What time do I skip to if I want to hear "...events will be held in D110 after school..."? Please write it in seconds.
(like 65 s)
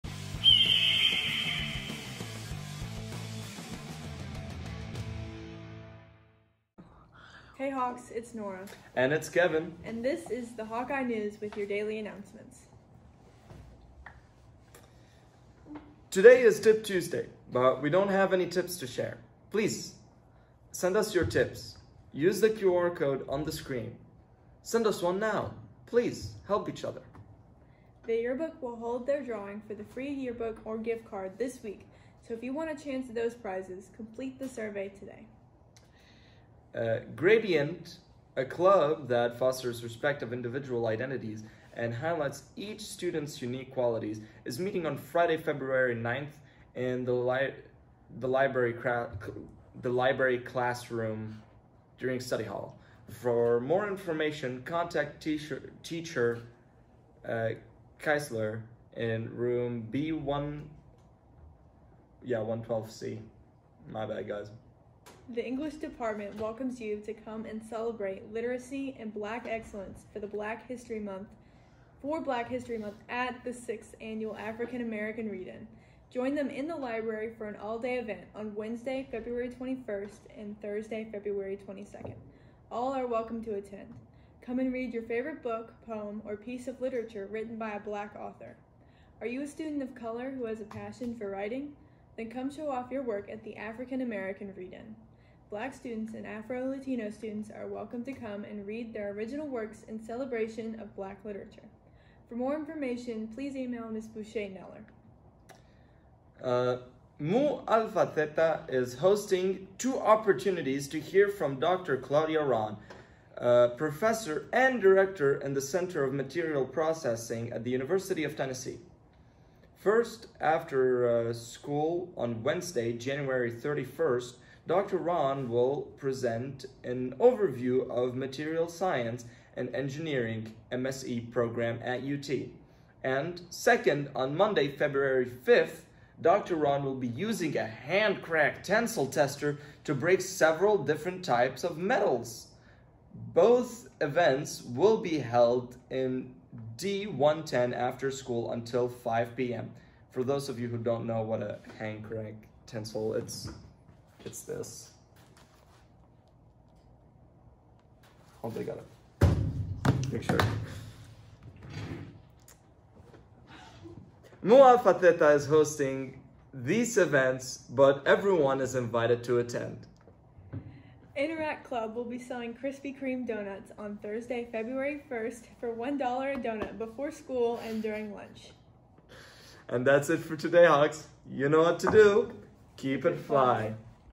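144 s.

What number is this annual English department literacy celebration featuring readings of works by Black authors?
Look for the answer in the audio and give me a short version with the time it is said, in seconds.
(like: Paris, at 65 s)
6th, at 73 s.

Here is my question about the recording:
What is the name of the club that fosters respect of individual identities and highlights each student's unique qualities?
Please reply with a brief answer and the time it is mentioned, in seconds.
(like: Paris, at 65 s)
Gradient, at 37 s.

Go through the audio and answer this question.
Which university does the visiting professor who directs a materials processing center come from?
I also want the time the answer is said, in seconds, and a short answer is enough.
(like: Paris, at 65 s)
University of Tennessee, at 117 s.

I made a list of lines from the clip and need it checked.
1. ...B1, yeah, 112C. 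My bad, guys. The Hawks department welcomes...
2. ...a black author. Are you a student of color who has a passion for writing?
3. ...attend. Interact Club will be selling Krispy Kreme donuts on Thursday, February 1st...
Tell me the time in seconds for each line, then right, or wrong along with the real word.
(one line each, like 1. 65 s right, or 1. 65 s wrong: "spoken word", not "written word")
1. 59 s wrong: "English", not "Hawks"
2. 87 s right
3. 169 s right.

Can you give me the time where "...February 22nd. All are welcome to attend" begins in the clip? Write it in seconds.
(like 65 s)
81 s.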